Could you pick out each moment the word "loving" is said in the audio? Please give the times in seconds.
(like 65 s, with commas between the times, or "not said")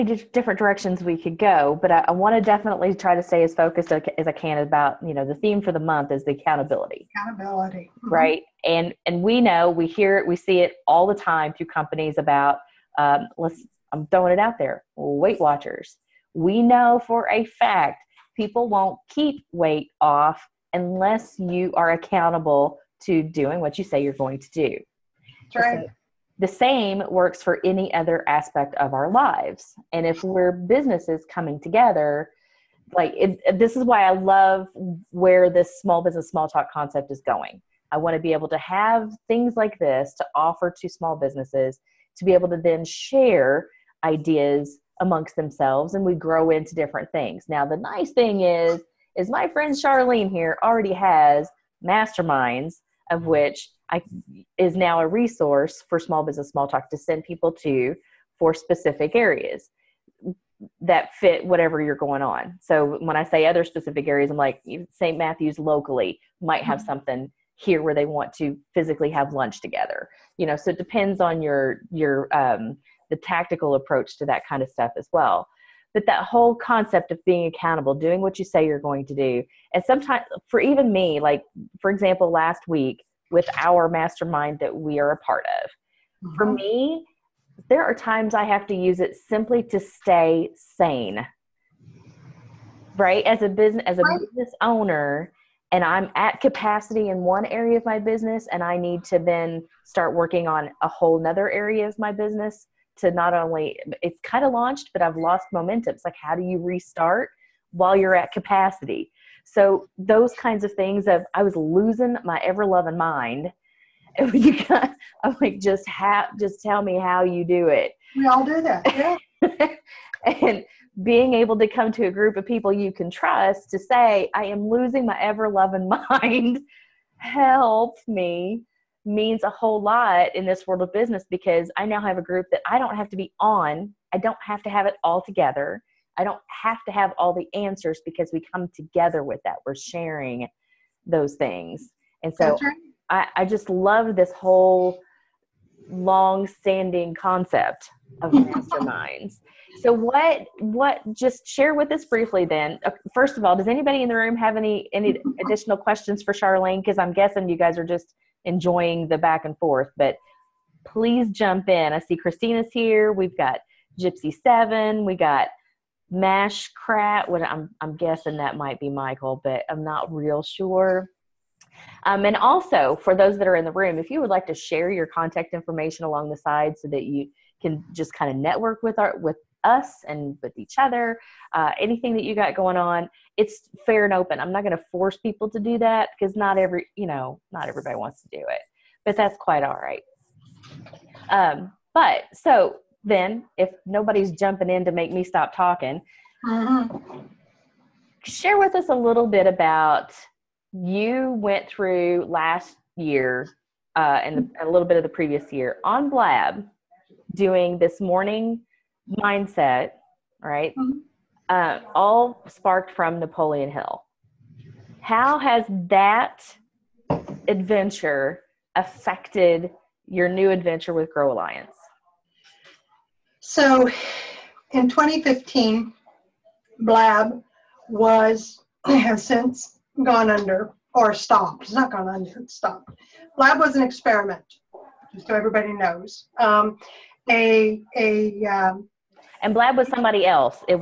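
112 s, 125 s.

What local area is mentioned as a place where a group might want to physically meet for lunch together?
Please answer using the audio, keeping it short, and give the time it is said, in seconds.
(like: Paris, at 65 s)
St. Matthews, at 64 s.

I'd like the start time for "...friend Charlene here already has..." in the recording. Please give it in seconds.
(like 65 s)
49 s.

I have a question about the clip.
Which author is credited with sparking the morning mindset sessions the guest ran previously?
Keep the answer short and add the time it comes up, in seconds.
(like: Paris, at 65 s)
Napoleon Hill, at 213 s.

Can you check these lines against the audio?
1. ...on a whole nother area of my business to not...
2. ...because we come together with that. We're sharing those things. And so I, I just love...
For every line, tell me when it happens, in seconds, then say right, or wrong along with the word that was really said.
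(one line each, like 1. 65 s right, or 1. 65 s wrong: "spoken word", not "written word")
1. 100 s right
2. 138 s right.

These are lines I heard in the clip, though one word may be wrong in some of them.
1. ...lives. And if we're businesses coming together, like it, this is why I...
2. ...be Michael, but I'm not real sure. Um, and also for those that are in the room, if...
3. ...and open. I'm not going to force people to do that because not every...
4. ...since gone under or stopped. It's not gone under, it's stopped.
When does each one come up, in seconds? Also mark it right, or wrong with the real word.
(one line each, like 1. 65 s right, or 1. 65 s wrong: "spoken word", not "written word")
1. 29 s right
2. 168 s right
3. 184 s right
4. 229 s right.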